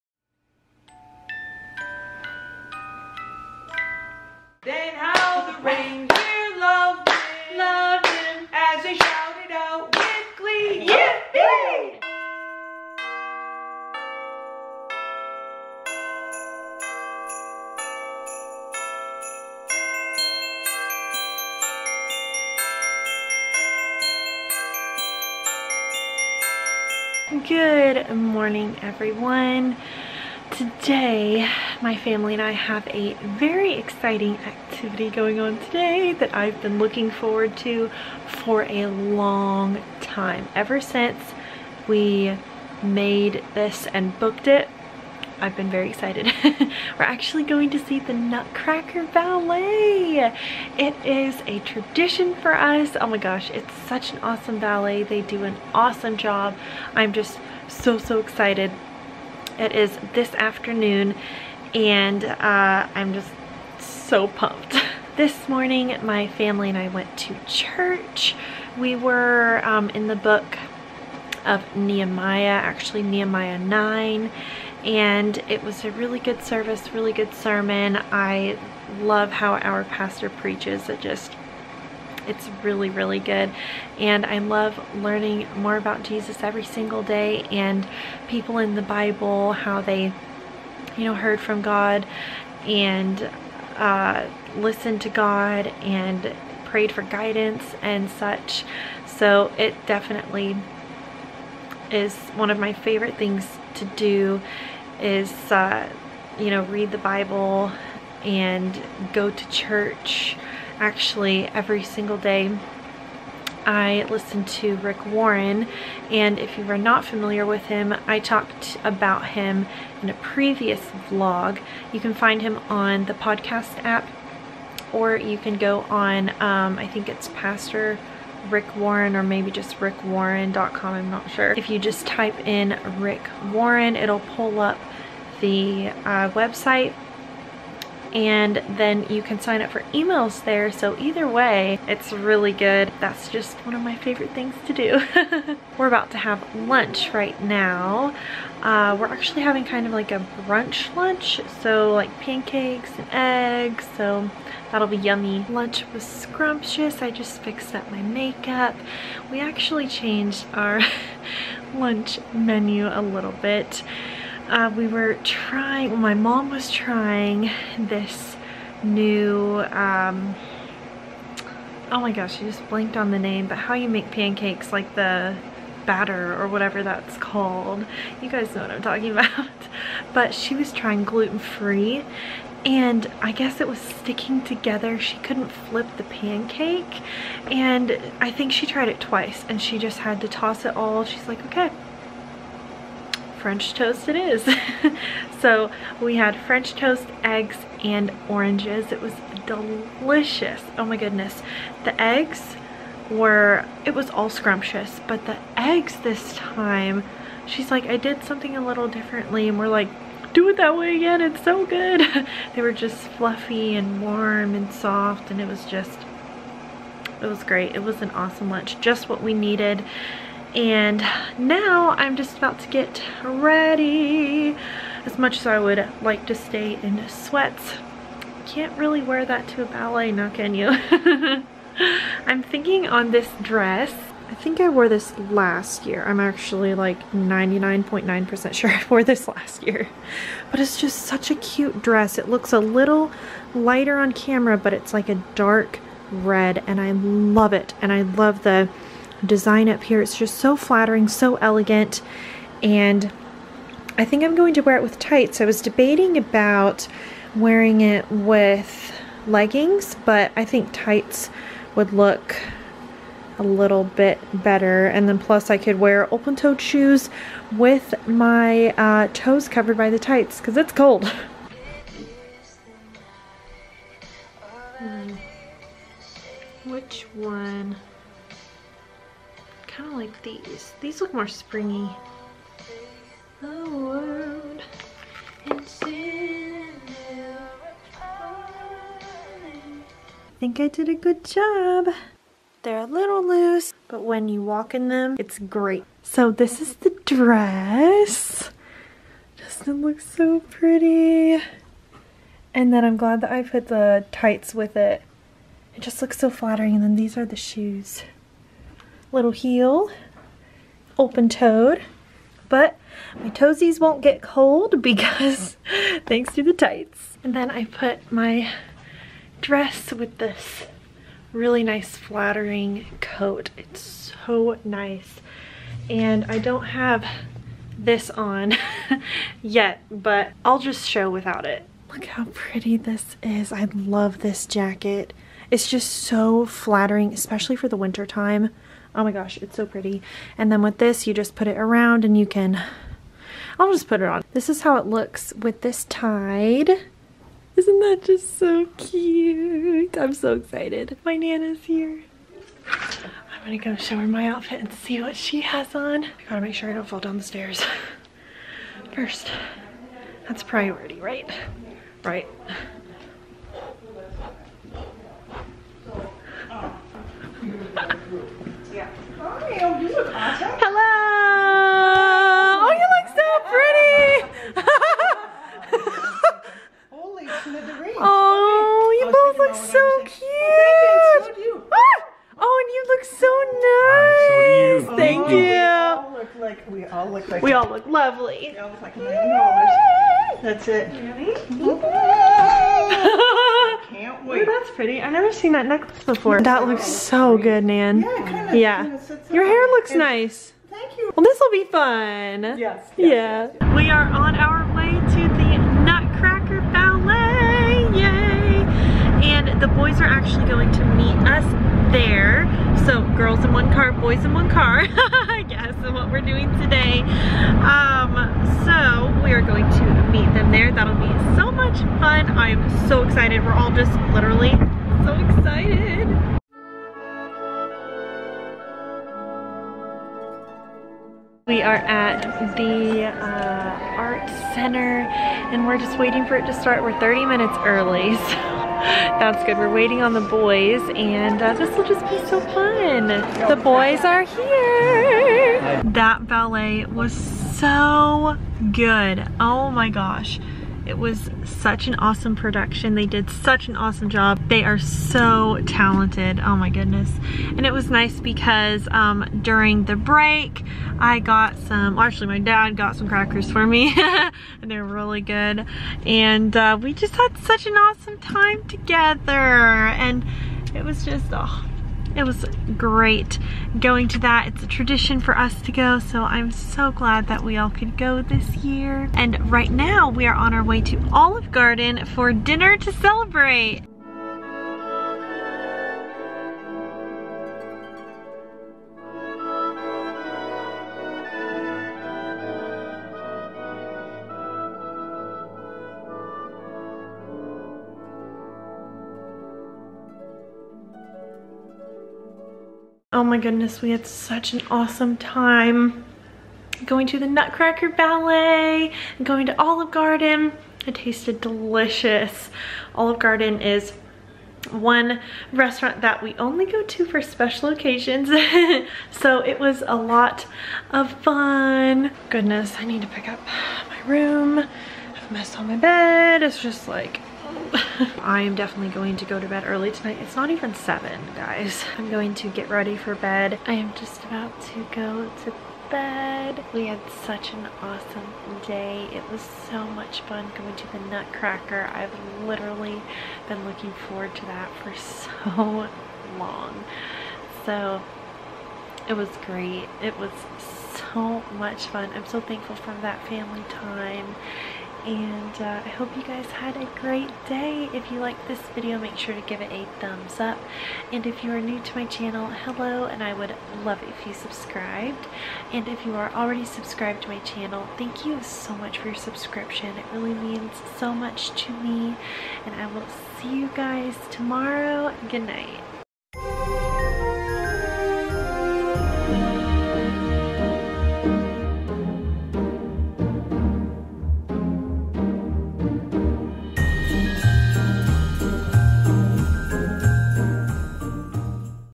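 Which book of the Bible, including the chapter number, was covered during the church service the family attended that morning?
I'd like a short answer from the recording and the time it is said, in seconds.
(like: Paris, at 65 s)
Nehemiah 9, at 73 s.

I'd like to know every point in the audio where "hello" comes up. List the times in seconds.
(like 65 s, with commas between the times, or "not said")
369 s, 562 s.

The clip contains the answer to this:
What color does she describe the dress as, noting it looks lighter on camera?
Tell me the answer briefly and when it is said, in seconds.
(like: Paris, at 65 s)
Dark red, at 245 s.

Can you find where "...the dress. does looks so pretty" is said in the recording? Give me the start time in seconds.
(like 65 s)
296 s.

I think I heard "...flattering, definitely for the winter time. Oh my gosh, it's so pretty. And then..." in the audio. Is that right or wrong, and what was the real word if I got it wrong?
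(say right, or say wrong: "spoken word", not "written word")
wrong: "especially", not "definitely".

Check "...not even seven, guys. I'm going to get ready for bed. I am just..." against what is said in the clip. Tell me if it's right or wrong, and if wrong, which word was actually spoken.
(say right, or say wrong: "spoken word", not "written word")
right.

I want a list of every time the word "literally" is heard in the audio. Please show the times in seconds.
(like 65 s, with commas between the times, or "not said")
424 s, 542 s.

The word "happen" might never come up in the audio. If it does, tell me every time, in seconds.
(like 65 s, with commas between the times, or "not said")
not said.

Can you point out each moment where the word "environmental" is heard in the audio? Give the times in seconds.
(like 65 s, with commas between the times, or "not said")
not said.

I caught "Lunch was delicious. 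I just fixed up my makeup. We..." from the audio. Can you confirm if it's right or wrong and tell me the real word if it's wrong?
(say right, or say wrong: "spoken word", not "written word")
wrong: "scrumptious", not "delicious".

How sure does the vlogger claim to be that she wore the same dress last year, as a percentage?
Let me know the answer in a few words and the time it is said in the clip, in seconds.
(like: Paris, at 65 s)
99.9%, at 237 s.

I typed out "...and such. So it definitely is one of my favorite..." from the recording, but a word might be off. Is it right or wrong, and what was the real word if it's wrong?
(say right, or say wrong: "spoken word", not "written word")
right.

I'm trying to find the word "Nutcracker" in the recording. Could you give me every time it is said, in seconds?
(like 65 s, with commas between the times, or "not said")
48 s, 405 s, 507 s, 540 s.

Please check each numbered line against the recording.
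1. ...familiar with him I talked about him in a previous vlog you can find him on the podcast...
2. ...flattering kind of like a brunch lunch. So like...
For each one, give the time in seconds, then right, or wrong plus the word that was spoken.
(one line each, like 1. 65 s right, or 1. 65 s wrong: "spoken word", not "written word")
1. 117 s right
2. 149 s wrong: "having", not "flattering".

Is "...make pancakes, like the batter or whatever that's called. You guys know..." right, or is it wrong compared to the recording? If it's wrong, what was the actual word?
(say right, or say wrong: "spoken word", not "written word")
right.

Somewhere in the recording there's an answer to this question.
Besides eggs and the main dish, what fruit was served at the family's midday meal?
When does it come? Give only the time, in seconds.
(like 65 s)
198 s.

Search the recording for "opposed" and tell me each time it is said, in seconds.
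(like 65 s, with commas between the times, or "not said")
not said.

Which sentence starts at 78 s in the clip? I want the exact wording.
I love how our pastor preaches.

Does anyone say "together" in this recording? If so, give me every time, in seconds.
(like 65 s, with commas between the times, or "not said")
184 s, 468 s.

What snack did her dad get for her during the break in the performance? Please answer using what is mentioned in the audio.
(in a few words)
Crackers.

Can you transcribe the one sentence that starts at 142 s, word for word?
That's just one of my favorite things to do.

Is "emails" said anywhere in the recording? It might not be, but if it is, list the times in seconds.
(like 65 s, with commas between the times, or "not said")
139 s.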